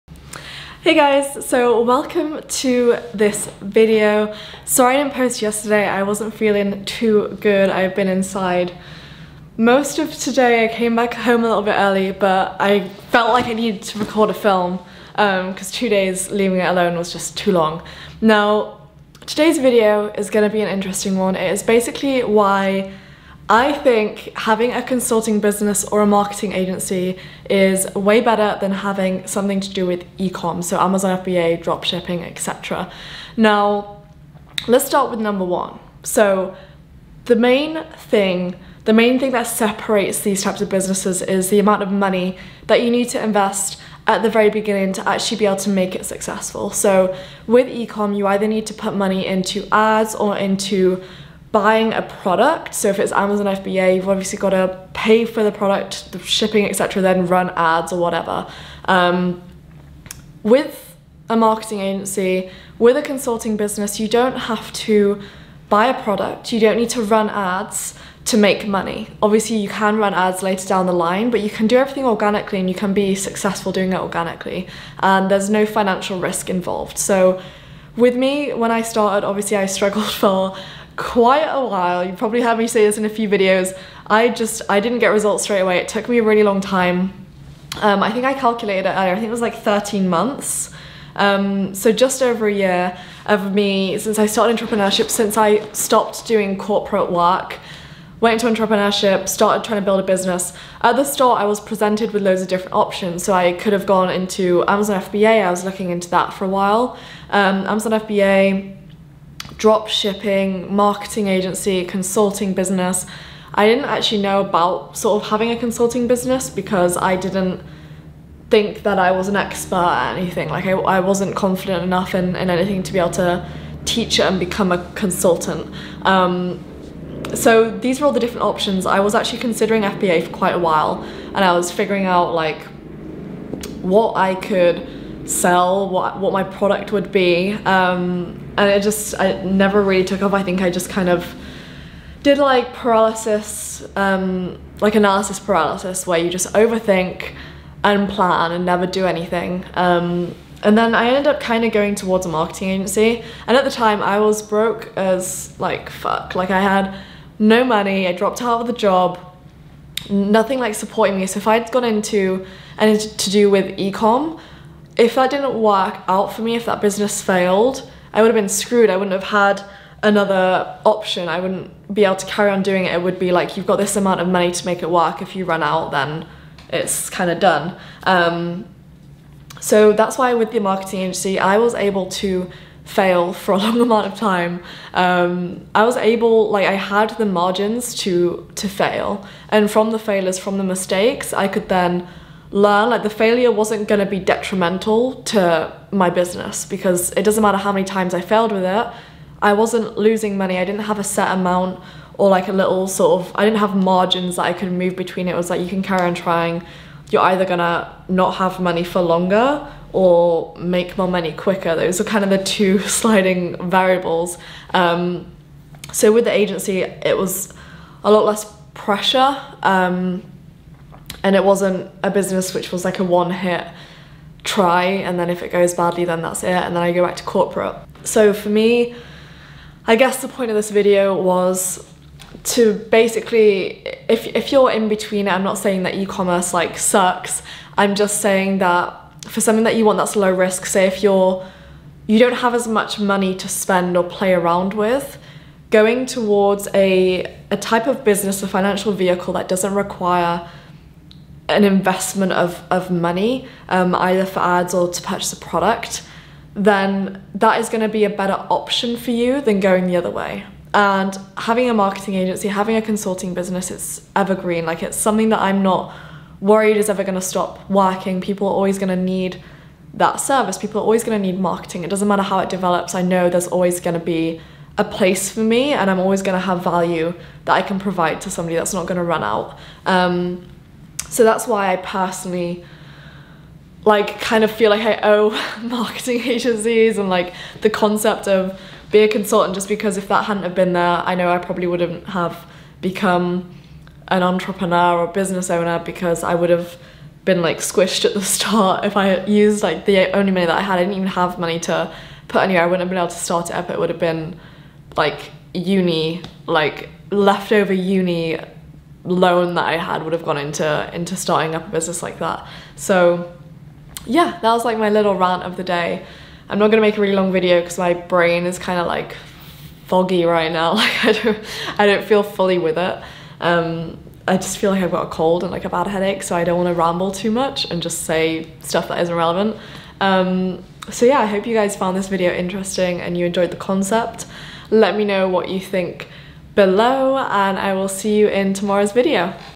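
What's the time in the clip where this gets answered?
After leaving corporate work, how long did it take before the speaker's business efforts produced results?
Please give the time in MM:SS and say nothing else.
01:29.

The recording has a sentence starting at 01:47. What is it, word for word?
Um, Amazon FBA, drop shipping, marketing agency, consulting business.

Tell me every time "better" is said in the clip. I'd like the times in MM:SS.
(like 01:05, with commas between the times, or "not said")
00:28, 04:18.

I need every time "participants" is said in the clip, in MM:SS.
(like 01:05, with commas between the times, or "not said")
not said.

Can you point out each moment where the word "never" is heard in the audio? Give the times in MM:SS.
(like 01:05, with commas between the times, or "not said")
02:19, 02:28.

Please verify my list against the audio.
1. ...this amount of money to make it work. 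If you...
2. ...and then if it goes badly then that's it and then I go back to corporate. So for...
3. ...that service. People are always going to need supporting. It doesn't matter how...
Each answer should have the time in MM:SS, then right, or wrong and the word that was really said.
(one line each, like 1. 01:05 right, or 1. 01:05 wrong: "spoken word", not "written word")
1. 02:53 right
2. 03:44 right
3. 04:29 wrong: "marketing", not "supporting".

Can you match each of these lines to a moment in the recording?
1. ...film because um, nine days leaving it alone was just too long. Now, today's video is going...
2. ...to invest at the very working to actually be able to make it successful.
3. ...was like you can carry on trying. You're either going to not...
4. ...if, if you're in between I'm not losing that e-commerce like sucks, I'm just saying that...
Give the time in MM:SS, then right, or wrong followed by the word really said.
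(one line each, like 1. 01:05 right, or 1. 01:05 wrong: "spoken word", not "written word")
1. 00:14 wrong: "two", not "nine"
2. 00:43 wrong: "beginning", not "working"
3. 03:25 right
4. 03:54 wrong: "saying", not "losing".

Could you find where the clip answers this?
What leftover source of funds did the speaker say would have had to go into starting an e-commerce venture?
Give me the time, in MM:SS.
05:07.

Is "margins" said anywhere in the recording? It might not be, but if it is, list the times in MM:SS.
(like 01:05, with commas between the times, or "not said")
03:07, 03:23.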